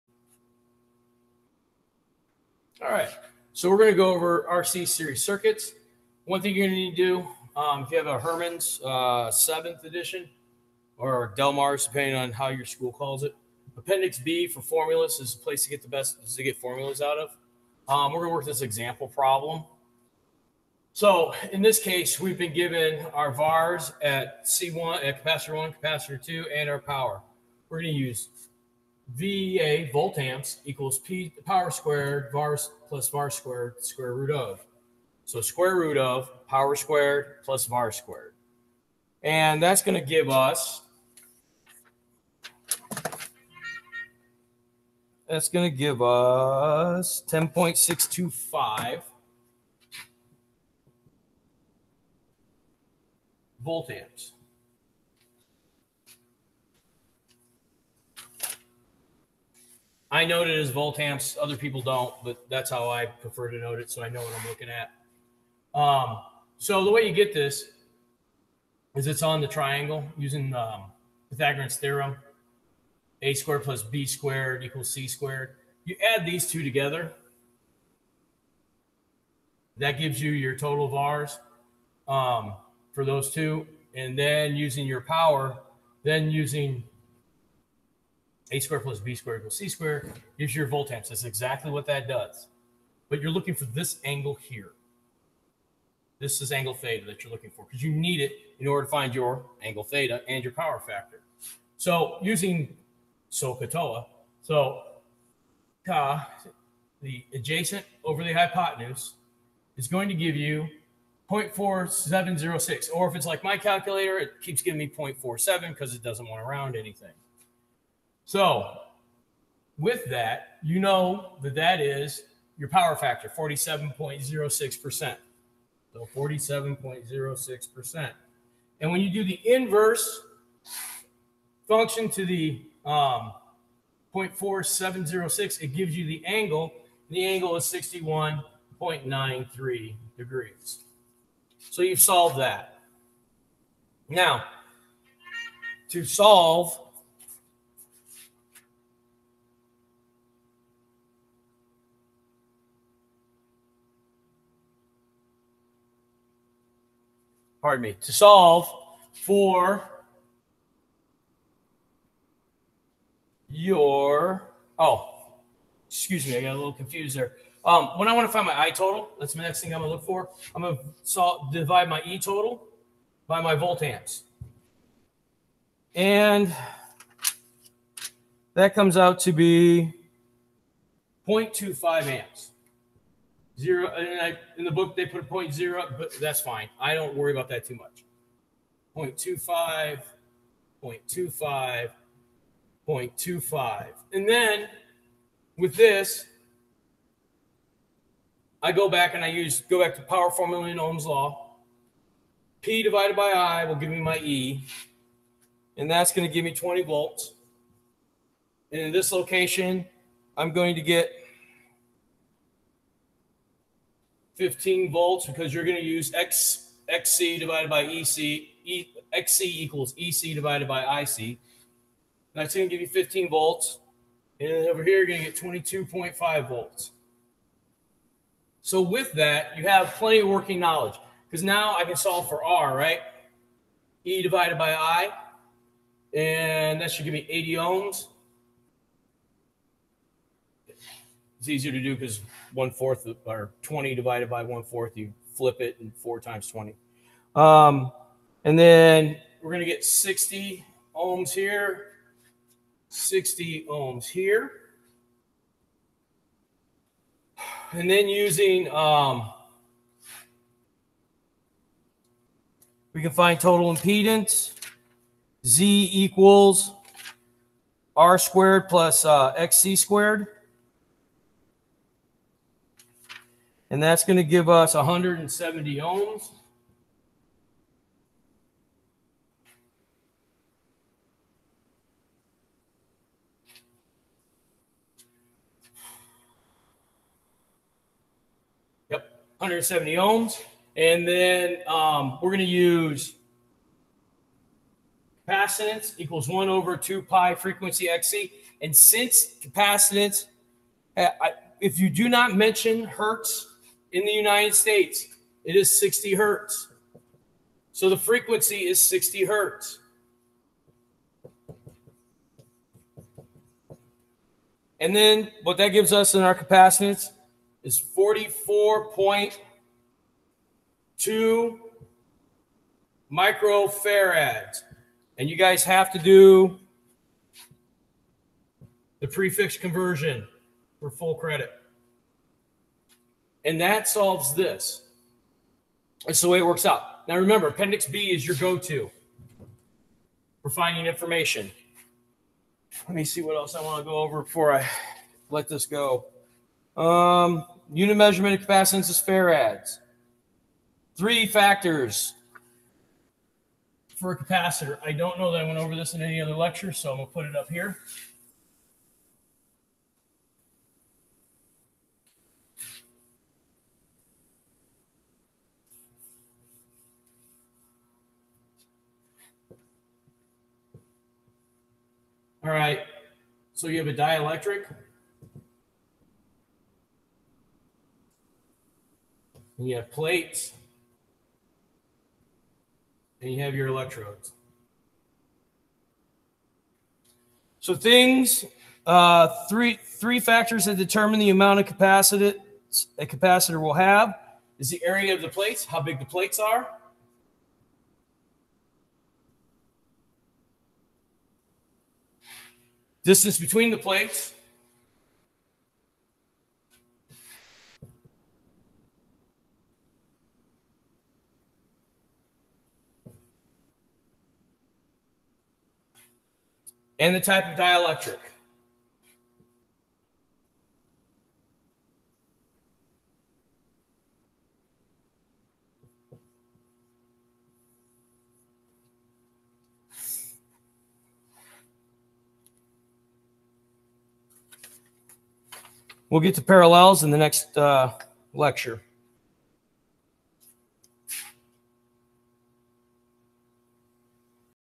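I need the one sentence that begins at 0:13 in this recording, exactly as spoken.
Appendix B for formulas is a place to get the best to get formulas out of.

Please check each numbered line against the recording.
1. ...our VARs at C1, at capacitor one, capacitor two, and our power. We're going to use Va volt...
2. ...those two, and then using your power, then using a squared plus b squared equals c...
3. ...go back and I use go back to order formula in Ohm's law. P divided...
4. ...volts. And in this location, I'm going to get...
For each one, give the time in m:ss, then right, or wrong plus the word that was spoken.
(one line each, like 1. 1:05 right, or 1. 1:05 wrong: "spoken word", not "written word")
1. 0:23 right
2. 1:23 right
3. 3:18 wrong: "power", not "order"
4. 3:26 right.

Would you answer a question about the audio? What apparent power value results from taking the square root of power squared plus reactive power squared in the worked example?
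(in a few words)
10.625 volt amps.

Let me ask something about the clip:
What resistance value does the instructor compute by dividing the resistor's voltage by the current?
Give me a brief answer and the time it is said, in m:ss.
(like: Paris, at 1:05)
80 ohms, at 3:57.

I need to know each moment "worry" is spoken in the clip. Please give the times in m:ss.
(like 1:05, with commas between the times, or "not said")
3:07.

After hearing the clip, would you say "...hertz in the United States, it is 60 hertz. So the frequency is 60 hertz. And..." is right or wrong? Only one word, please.
right.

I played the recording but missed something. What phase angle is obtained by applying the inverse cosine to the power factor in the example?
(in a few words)
61.93 degrees.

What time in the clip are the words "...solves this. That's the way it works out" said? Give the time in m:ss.
5:33.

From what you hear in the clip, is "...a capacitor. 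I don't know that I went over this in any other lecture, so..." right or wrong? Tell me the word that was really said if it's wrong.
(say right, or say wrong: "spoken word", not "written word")
right.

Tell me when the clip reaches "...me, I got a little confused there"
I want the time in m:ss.
2:46.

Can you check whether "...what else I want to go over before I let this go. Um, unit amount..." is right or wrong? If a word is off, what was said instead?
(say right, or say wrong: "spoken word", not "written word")
wrong: "measurement", not "amount".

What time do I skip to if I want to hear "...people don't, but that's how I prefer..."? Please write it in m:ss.
1:01.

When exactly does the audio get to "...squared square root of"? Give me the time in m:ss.
0:33.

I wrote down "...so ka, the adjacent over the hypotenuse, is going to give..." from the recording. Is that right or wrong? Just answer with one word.
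right.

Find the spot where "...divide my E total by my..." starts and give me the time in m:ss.
2:51.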